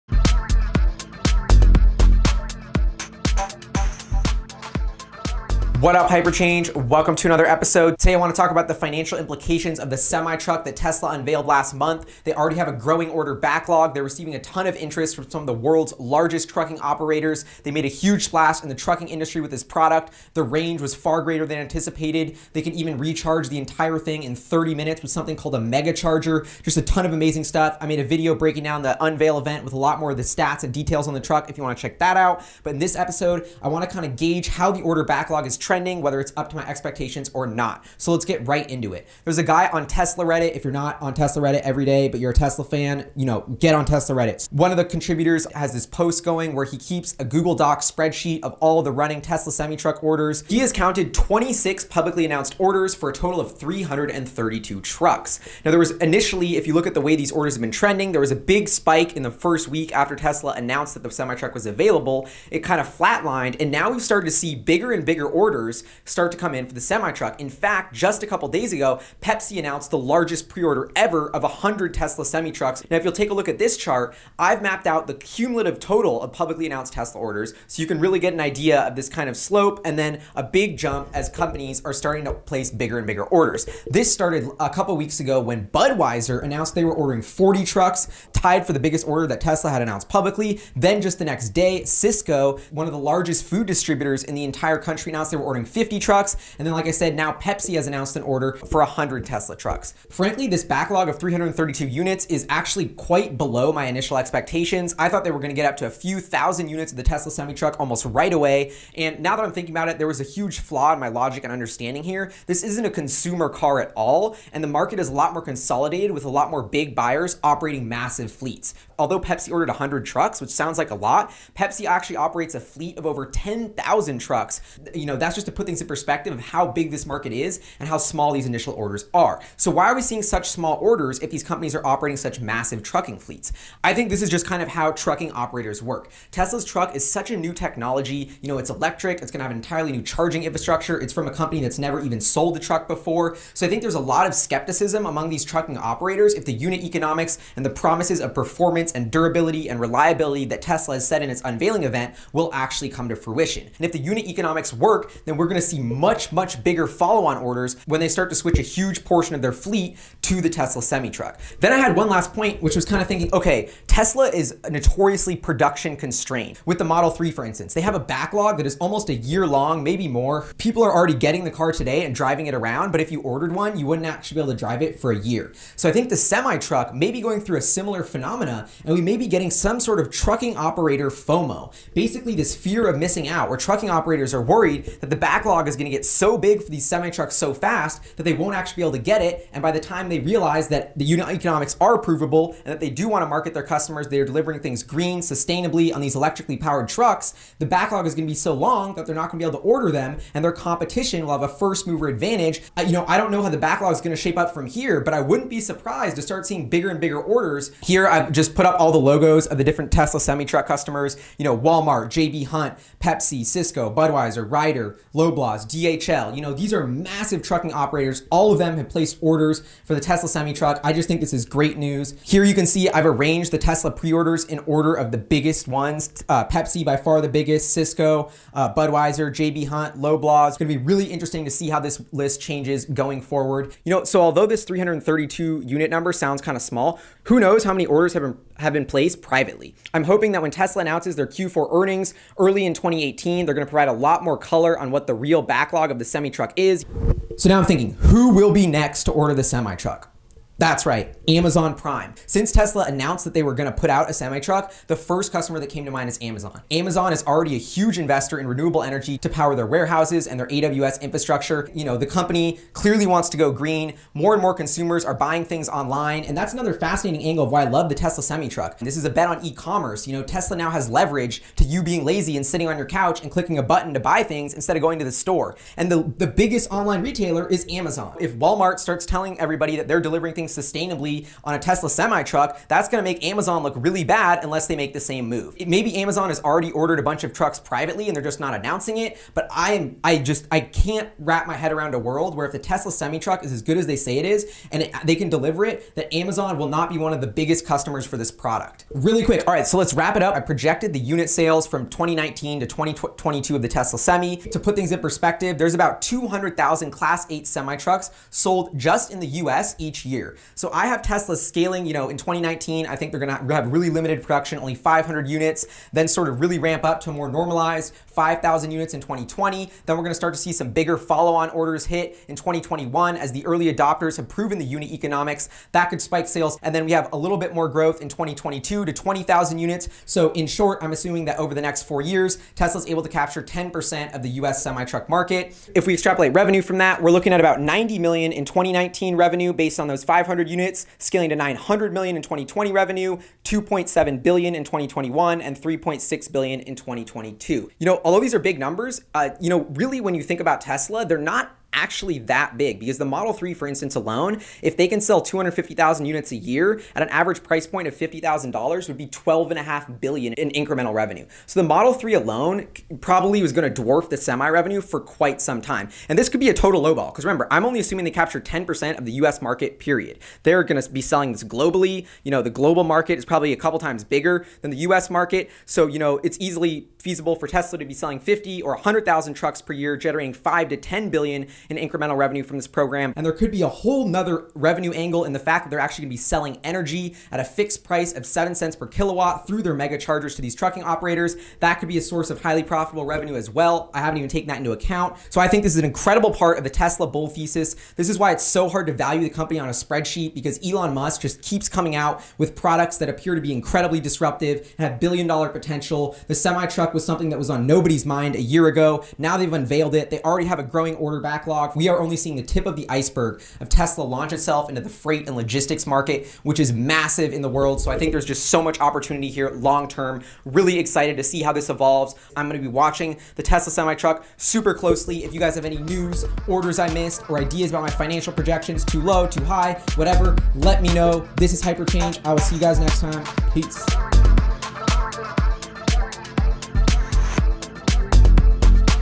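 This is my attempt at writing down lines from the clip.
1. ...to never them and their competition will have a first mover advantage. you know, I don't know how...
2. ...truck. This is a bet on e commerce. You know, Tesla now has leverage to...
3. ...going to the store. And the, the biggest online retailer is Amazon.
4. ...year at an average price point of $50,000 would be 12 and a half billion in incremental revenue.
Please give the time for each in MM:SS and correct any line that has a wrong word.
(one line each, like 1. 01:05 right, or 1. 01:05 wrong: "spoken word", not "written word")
1. 03:19 wrong: "order", not "never"
2. 04:28 right
3. 04:34 right
4. 05:56 right.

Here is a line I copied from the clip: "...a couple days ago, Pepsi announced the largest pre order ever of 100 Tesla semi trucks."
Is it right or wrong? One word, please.
right.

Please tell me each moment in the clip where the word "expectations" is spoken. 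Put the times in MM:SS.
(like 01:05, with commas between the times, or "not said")
00:36, 01:44.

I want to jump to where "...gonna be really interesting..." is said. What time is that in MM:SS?
03:50.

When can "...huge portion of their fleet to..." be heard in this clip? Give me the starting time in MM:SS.
02:38.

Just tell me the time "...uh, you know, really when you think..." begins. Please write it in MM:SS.
05:49.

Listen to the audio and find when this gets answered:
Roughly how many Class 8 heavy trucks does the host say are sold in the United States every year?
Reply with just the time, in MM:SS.
05:06.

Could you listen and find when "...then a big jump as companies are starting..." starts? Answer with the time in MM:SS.
01:19.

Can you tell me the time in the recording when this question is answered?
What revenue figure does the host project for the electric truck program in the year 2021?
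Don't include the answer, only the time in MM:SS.
05:43.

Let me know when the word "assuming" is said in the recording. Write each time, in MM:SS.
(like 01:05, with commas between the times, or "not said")
05:30, 06:07.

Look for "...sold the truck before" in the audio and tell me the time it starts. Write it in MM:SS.
02:22.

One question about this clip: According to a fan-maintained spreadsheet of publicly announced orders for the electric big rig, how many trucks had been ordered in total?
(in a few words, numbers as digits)
332.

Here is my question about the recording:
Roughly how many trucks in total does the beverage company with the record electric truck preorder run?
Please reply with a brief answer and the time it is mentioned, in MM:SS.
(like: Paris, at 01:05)
10,000, at 02:03.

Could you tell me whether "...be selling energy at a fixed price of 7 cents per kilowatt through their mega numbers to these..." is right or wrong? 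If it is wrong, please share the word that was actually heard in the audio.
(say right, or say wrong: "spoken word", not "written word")
wrong: "chargers", not "numbers".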